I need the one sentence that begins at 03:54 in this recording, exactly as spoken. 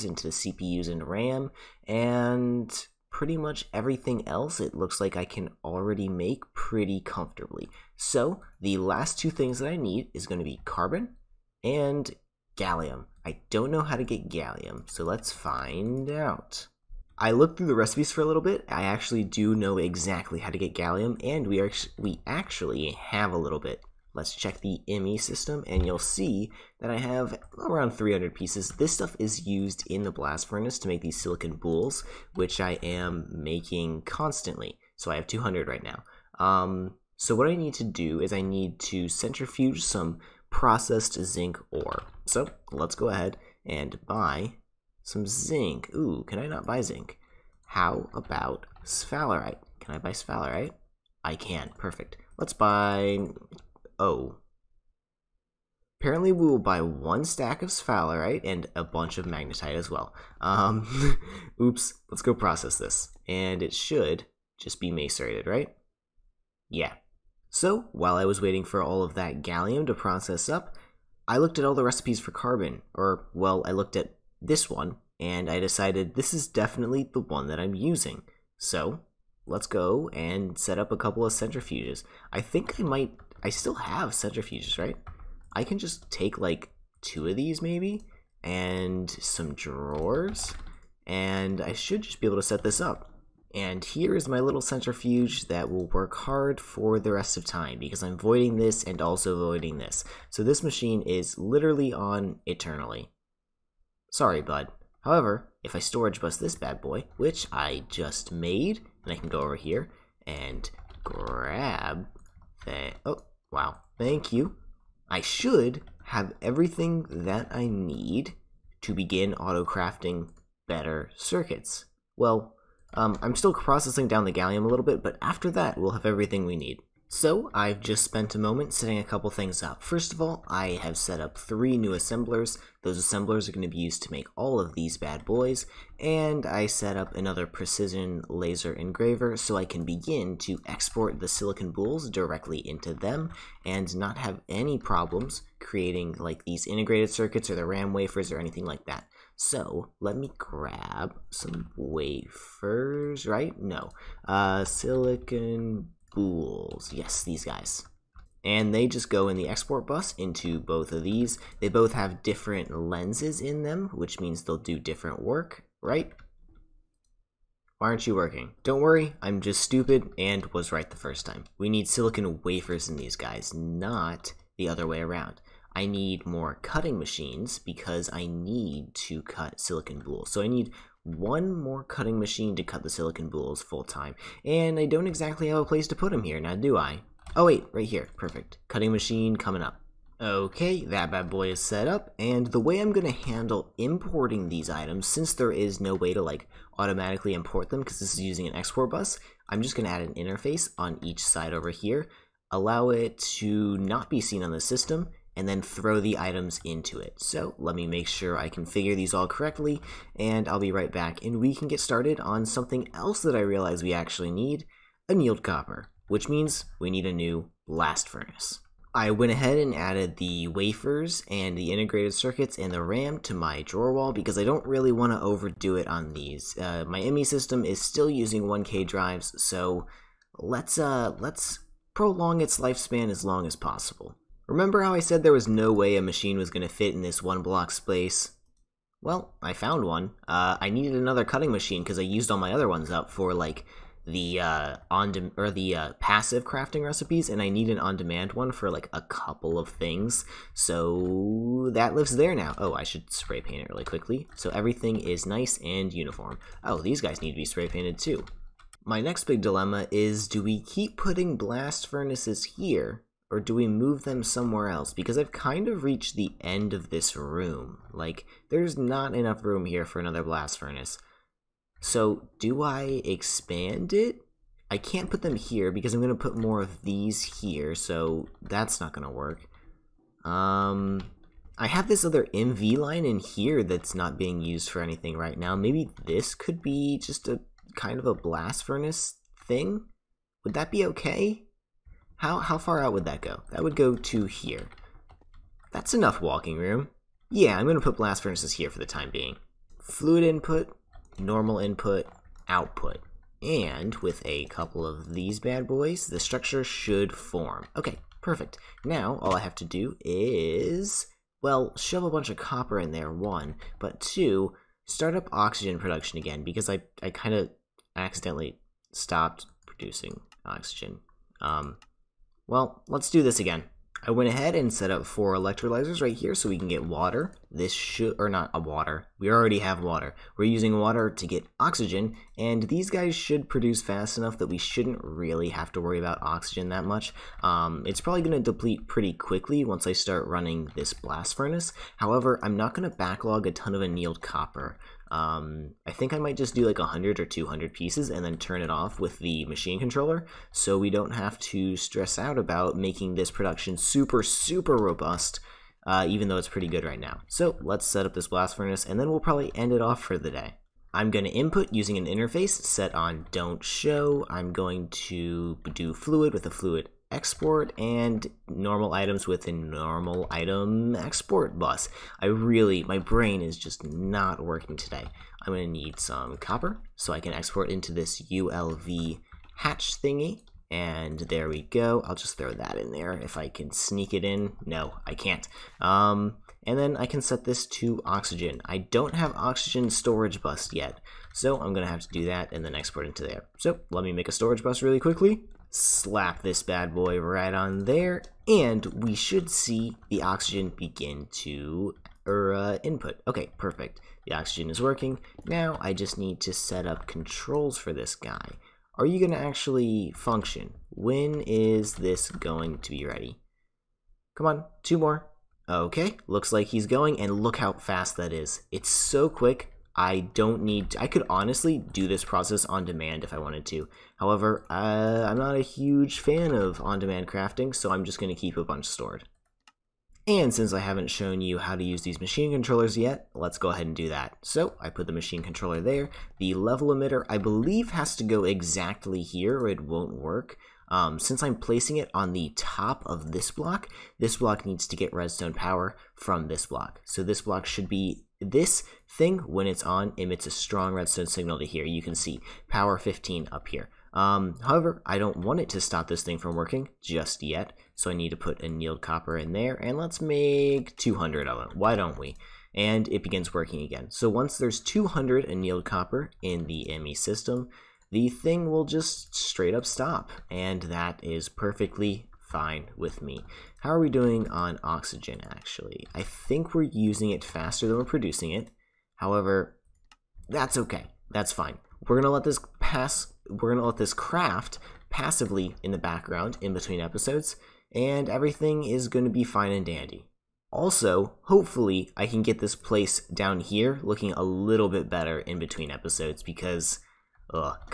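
Remember how I said there was no way a machine was going to fit in this one block space?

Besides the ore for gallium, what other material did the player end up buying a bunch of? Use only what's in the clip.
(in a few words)
magnetite.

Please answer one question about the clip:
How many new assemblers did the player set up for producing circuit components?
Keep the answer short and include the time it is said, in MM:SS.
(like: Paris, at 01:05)
3, at 02:11.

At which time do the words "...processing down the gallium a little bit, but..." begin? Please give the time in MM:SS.
02:03.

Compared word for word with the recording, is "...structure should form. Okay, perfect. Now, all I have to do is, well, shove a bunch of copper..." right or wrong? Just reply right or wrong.
right.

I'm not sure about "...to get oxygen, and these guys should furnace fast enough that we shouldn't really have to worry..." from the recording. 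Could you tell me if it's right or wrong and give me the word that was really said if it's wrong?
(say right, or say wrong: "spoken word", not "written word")
wrong: "produce", not "furnace".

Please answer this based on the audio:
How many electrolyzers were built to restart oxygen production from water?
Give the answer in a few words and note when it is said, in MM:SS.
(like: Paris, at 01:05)
4, at 05:25.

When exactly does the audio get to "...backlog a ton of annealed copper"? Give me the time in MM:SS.
05:42.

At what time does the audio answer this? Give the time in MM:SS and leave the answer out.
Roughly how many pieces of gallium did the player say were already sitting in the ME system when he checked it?
00:27.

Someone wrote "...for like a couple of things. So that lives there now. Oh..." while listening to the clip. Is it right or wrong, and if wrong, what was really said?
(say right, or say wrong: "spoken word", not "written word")
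right.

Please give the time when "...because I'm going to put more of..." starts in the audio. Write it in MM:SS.
04:35.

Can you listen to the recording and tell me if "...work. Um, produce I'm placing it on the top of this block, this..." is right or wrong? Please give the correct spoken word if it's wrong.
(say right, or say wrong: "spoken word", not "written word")
wrong: "since", not "produce".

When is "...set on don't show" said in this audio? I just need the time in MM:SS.
06:02.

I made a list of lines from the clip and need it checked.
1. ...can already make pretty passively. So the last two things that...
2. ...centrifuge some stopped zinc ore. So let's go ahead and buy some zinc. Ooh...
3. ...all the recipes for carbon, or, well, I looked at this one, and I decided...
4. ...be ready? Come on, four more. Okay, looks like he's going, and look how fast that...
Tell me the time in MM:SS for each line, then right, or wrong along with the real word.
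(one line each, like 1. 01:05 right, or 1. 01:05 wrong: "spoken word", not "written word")
1. 00:05 wrong: "comfortably", not "passively"
2. 00:39 wrong: "processed", not "stopped"
3. 01:11 right
4. 06:52 wrong: "two", not "four".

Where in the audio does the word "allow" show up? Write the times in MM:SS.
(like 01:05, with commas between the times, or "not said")
03:22.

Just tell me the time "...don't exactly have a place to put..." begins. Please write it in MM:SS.
03:04.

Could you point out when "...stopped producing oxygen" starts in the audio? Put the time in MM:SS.
05:18.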